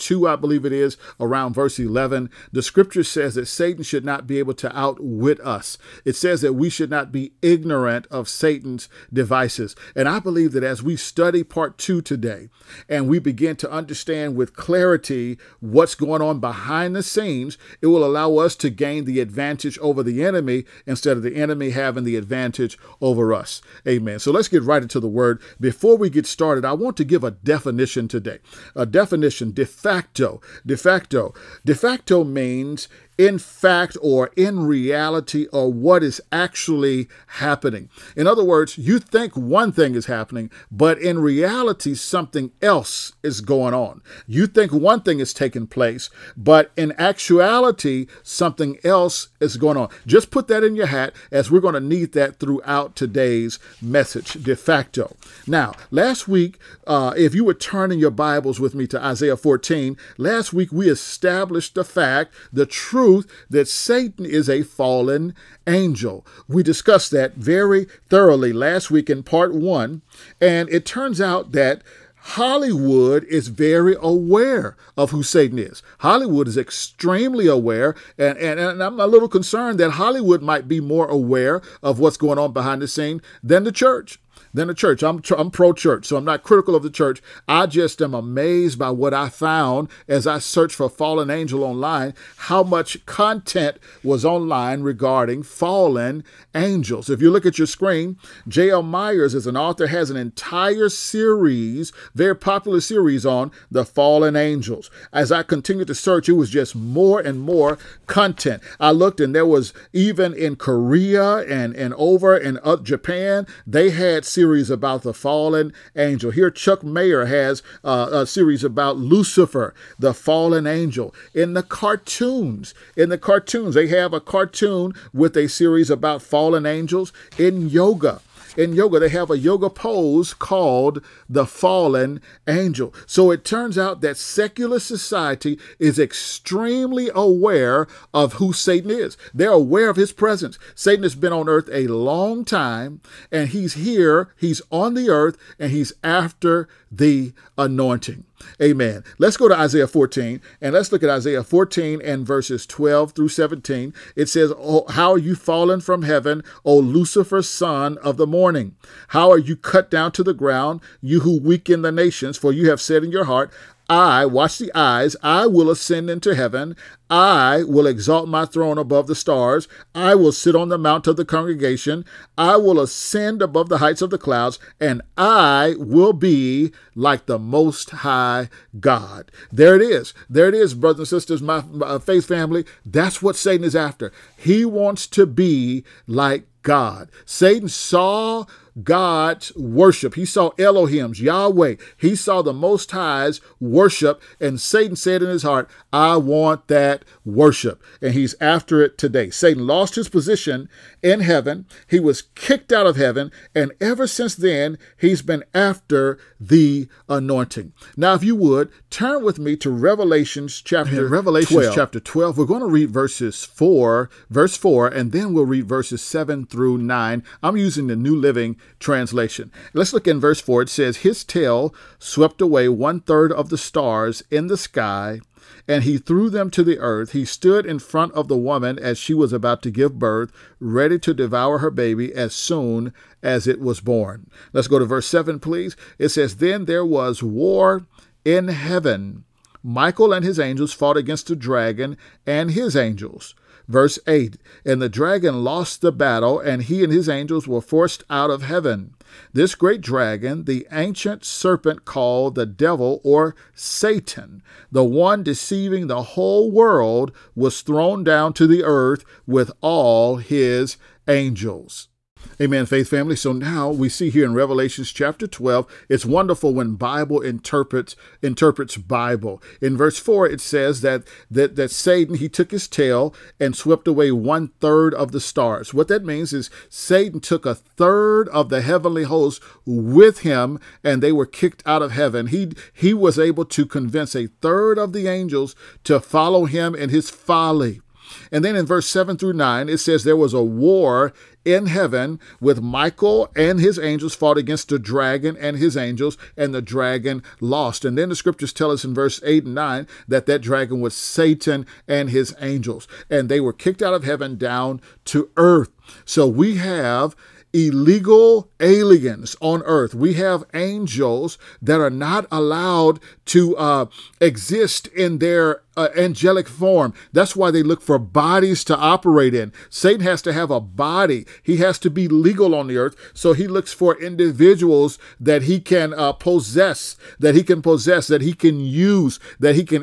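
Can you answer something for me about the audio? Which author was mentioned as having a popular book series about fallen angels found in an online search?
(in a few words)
J.L. Myers.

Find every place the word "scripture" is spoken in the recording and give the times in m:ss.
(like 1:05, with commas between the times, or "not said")
0:02, 4:58.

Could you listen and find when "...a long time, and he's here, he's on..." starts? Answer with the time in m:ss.
2:21.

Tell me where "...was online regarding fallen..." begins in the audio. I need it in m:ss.
1:34.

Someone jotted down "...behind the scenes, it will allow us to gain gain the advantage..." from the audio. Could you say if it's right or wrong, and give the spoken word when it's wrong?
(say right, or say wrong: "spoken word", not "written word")
right.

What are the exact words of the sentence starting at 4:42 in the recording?
He he was able to convince a third of the angels to follow him in his folly.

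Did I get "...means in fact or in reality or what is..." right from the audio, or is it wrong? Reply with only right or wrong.
right.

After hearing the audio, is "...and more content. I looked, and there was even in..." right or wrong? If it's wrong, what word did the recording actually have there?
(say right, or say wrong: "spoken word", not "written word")
right.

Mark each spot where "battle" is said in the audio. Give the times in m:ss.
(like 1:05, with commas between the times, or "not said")
4:05.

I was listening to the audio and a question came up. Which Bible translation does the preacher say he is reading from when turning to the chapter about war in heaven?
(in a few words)
New Living Translation.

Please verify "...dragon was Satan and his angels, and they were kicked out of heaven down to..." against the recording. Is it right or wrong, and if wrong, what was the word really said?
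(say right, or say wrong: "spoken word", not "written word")
right.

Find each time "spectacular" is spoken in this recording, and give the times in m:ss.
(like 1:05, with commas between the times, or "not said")
not said.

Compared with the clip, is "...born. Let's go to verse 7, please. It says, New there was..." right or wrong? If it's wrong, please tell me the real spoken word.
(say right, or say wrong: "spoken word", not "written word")
wrong: "Then", not "New".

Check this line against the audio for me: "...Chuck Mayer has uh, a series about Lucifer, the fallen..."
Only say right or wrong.
right.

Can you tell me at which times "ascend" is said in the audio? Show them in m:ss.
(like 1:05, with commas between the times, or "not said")
2:45, 2:52.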